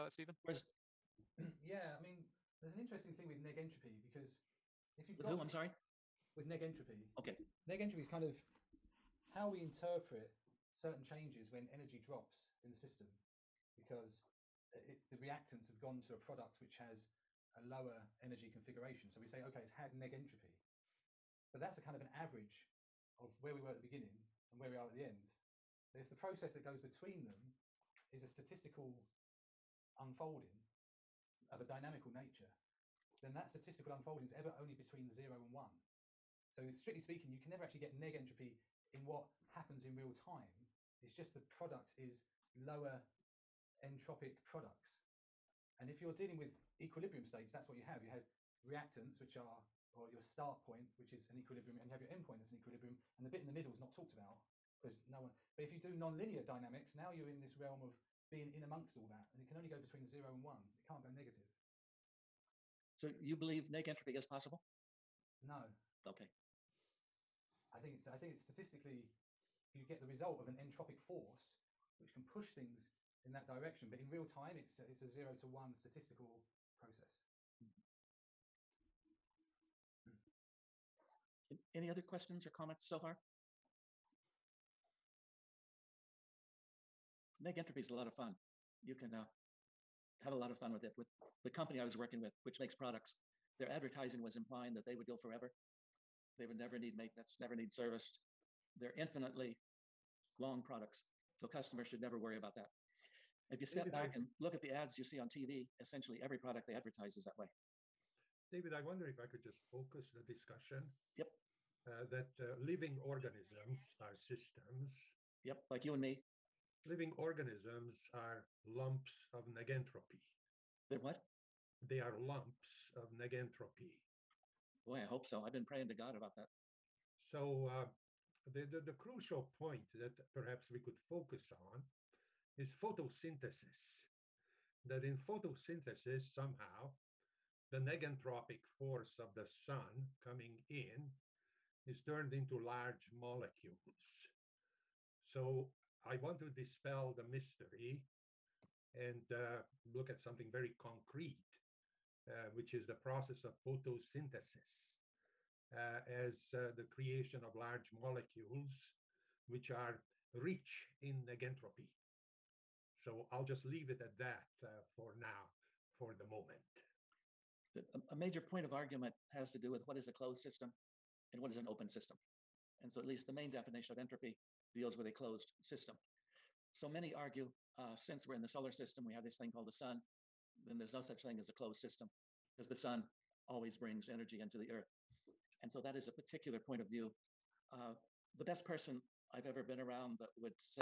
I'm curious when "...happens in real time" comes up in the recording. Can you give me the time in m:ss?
0:39.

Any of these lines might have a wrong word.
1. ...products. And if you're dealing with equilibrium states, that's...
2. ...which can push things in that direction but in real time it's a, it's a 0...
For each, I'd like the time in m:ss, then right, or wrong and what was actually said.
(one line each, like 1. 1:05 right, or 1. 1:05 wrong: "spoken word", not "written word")
1. 0:44 right
2. 1:11 right.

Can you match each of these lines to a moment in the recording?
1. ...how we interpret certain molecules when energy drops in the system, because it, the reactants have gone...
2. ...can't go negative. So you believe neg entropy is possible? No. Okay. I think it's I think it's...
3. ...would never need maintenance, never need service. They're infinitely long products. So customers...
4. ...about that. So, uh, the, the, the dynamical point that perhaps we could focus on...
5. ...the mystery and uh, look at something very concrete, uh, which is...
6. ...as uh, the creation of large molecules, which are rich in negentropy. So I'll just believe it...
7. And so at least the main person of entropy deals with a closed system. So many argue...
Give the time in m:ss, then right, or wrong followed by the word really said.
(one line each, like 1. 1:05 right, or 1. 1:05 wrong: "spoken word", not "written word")
1. 0:09 wrong: "changes", not "molecules"
2. 1:00 right
3. 1:36 right
4. 2:06 wrong: "crucial", not "dynamical"
5. 2:27 right
6. 2:36 wrong: "leave", not "believe"
7. 2:52 wrong: "definition", not "person".